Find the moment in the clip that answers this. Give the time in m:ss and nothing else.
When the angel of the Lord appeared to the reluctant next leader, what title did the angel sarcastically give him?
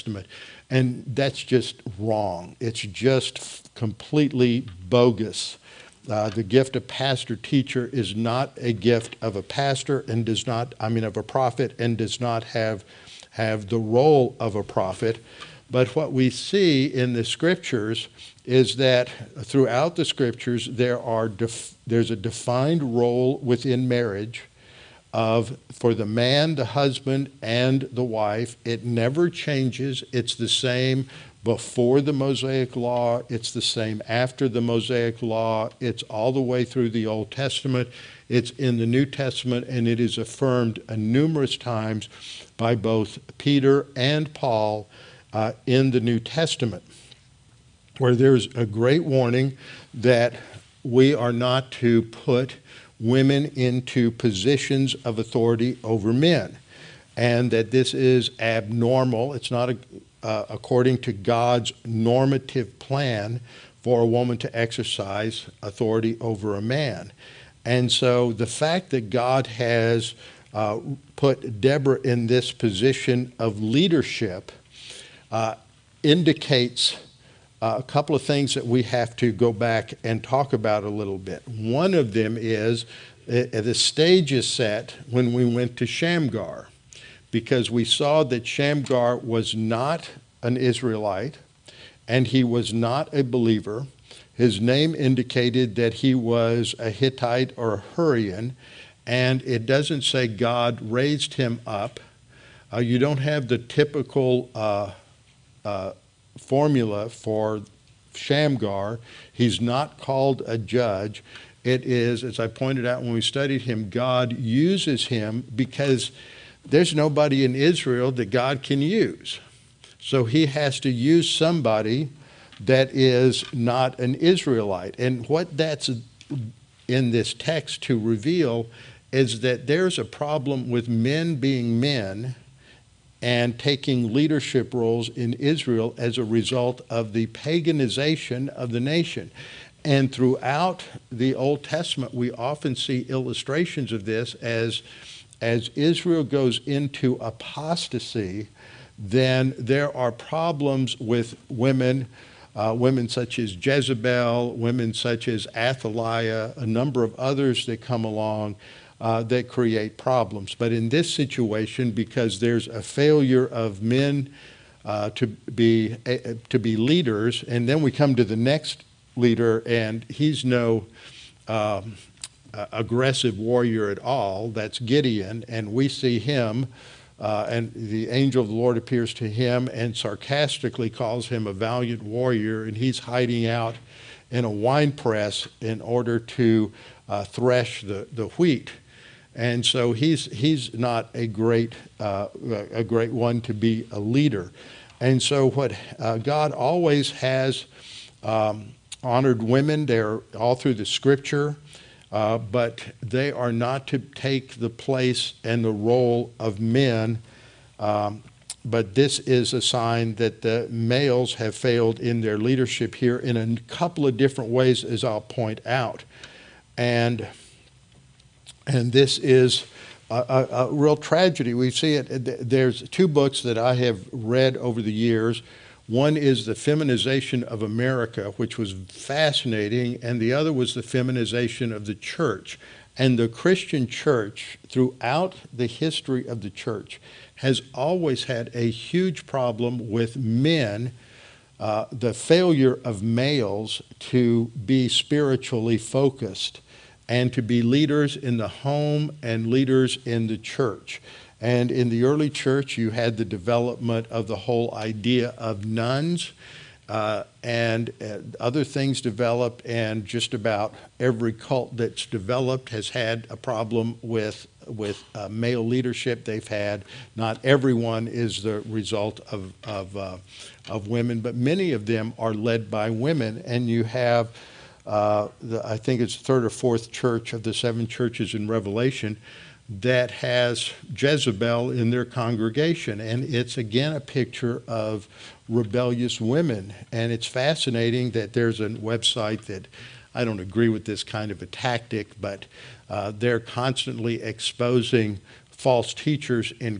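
3:01.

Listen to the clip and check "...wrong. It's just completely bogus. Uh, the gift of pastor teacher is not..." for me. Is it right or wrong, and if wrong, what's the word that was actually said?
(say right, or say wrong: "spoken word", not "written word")
right.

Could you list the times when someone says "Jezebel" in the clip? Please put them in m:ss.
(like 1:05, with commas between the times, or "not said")
2:33, 4:40.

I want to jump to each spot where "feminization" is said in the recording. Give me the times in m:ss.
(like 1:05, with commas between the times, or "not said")
3:46, 3:50.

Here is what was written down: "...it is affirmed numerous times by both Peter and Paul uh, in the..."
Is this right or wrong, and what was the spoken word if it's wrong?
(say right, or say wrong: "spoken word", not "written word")
right.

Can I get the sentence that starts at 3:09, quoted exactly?
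And so he's, he's not a great, uh, a great one to be a leader.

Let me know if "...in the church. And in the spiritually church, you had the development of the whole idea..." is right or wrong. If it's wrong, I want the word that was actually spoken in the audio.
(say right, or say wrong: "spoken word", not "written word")
wrong: "early", not "spiritually".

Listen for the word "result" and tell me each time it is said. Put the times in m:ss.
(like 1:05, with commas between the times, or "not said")
2:16, 4:28.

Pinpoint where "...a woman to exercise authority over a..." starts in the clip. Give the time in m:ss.
1:04.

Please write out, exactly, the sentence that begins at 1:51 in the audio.
It is, as I pointed out when we studied him, God uses him because there's nobody in Israel that God can use.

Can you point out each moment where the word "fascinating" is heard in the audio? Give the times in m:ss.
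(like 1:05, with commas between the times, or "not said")
3:48, 4:47.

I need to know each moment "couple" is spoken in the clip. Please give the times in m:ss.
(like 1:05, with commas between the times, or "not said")
1:17, 3:33.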